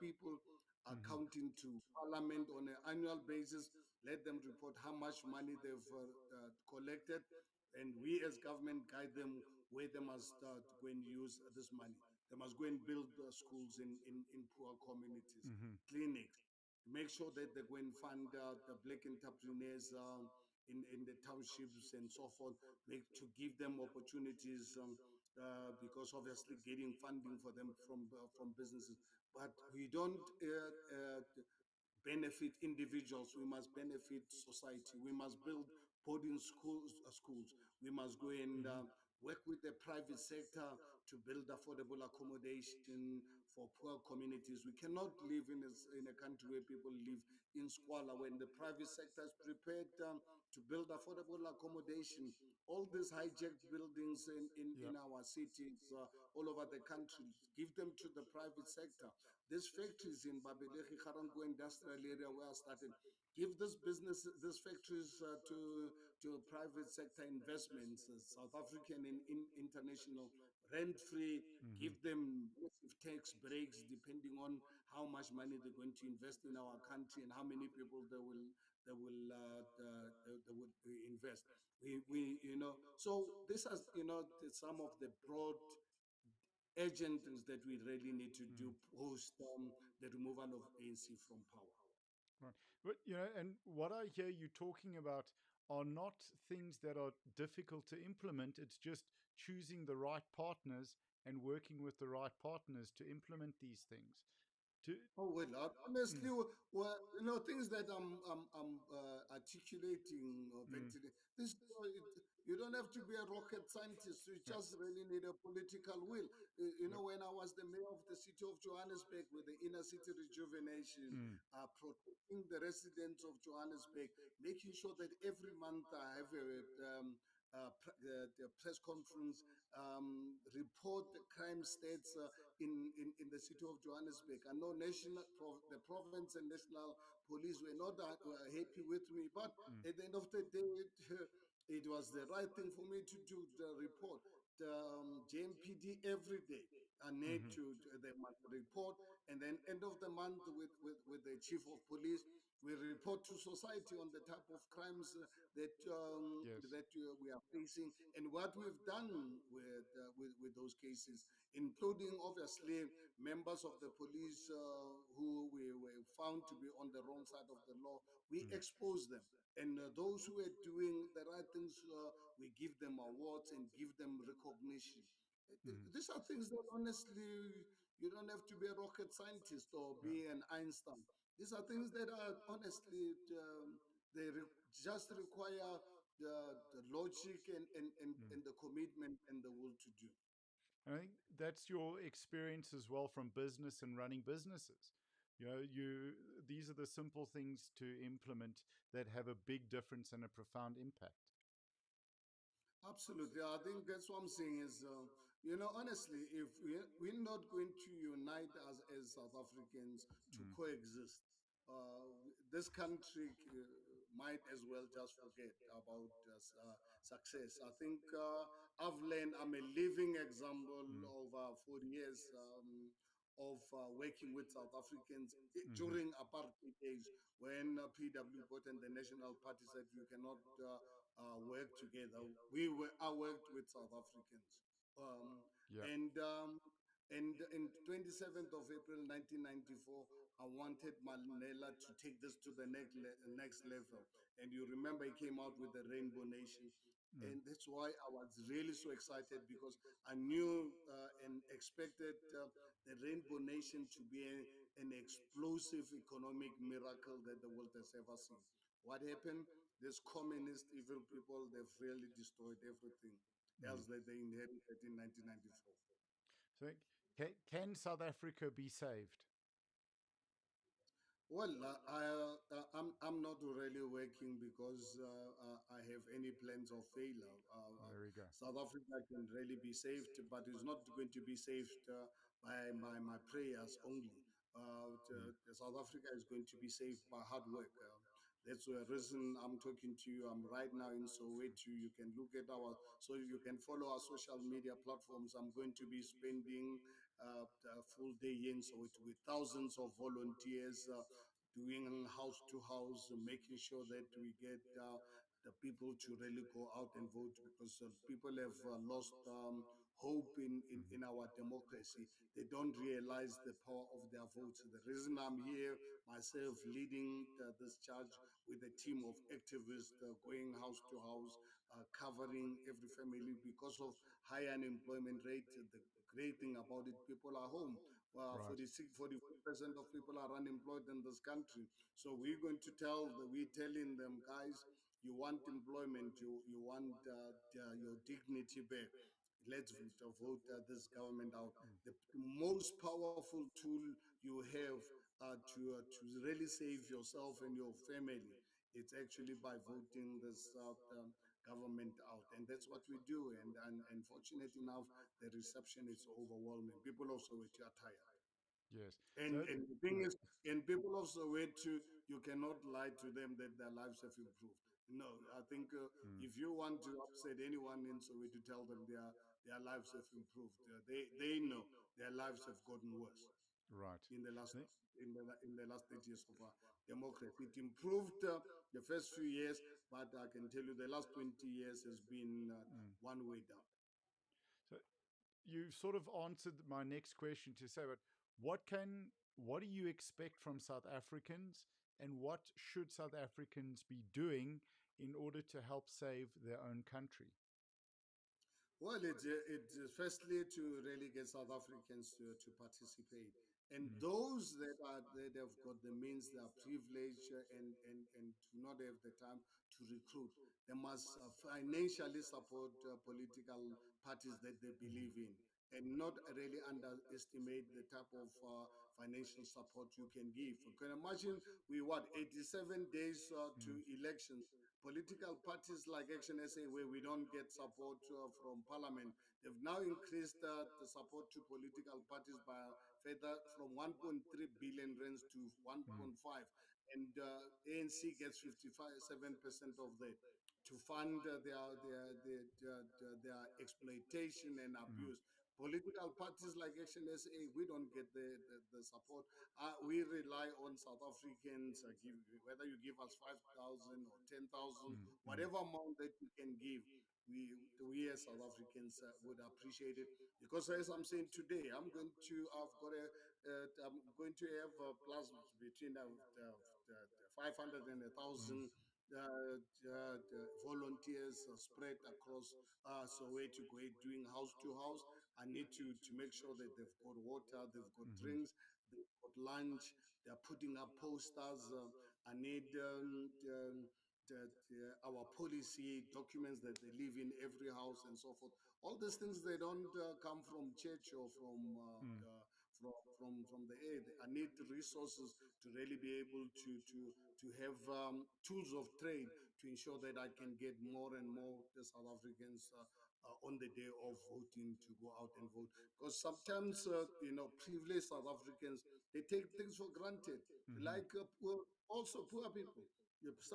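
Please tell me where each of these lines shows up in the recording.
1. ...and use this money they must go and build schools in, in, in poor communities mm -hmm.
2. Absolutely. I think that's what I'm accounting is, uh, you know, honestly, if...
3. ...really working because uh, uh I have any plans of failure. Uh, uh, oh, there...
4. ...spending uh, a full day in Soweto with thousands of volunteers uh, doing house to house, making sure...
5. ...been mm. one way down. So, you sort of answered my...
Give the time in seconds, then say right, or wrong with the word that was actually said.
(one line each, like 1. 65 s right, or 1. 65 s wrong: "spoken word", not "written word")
1. 10 s right
2. 202 s wrong: "saying", not "accounting"
3. 273 s right
4. 296 s right
5. 382 s right.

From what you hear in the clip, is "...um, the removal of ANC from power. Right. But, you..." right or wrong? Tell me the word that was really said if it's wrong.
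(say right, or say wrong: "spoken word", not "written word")
right.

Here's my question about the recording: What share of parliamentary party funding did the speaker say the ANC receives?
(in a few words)
57%.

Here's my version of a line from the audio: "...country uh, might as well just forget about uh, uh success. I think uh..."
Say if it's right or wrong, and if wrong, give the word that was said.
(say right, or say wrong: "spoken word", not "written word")
right.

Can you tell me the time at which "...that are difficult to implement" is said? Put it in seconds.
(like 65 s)
96 s.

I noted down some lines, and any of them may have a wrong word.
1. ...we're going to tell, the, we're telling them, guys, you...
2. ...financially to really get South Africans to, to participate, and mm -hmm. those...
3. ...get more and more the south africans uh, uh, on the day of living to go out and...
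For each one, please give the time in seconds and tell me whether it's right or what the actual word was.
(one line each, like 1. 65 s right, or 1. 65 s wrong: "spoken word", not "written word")
1. 332 s right
2. 399 s wrong: "firstly", not "financially"
3. 500 s wrong: "voting", not "living".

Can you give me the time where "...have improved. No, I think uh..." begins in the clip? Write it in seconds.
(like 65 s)
363 s.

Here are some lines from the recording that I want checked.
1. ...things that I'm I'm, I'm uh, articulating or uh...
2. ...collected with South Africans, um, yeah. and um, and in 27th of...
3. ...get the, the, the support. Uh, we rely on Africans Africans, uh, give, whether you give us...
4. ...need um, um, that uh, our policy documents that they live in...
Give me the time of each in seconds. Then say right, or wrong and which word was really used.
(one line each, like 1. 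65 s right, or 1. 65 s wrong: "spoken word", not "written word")
1. 107 s right
2. 233 s wrong: "worked", not "collected"
3. 447 s wrong: "South", not "Africans"
4. 482 s right.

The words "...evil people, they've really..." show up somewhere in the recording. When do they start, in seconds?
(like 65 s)
260 s.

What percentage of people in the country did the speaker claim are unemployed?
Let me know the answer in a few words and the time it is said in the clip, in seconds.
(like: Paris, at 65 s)
46%, at 328 s.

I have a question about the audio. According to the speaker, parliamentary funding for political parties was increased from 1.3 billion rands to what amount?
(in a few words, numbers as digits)
1.5 billion rands.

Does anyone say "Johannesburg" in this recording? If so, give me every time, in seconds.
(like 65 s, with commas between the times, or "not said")
118 s, 123 s, 133 s.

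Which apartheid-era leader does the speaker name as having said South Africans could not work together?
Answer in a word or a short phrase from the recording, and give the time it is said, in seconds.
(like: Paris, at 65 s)
PW Botha, at 227 s.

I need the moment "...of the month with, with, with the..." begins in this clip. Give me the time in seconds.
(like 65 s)
149 s.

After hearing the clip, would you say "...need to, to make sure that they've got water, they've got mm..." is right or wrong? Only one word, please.
right.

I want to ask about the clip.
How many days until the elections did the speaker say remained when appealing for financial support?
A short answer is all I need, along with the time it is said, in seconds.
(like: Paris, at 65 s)
87, at 422 s.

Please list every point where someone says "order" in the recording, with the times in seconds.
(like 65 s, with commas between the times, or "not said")
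395 s.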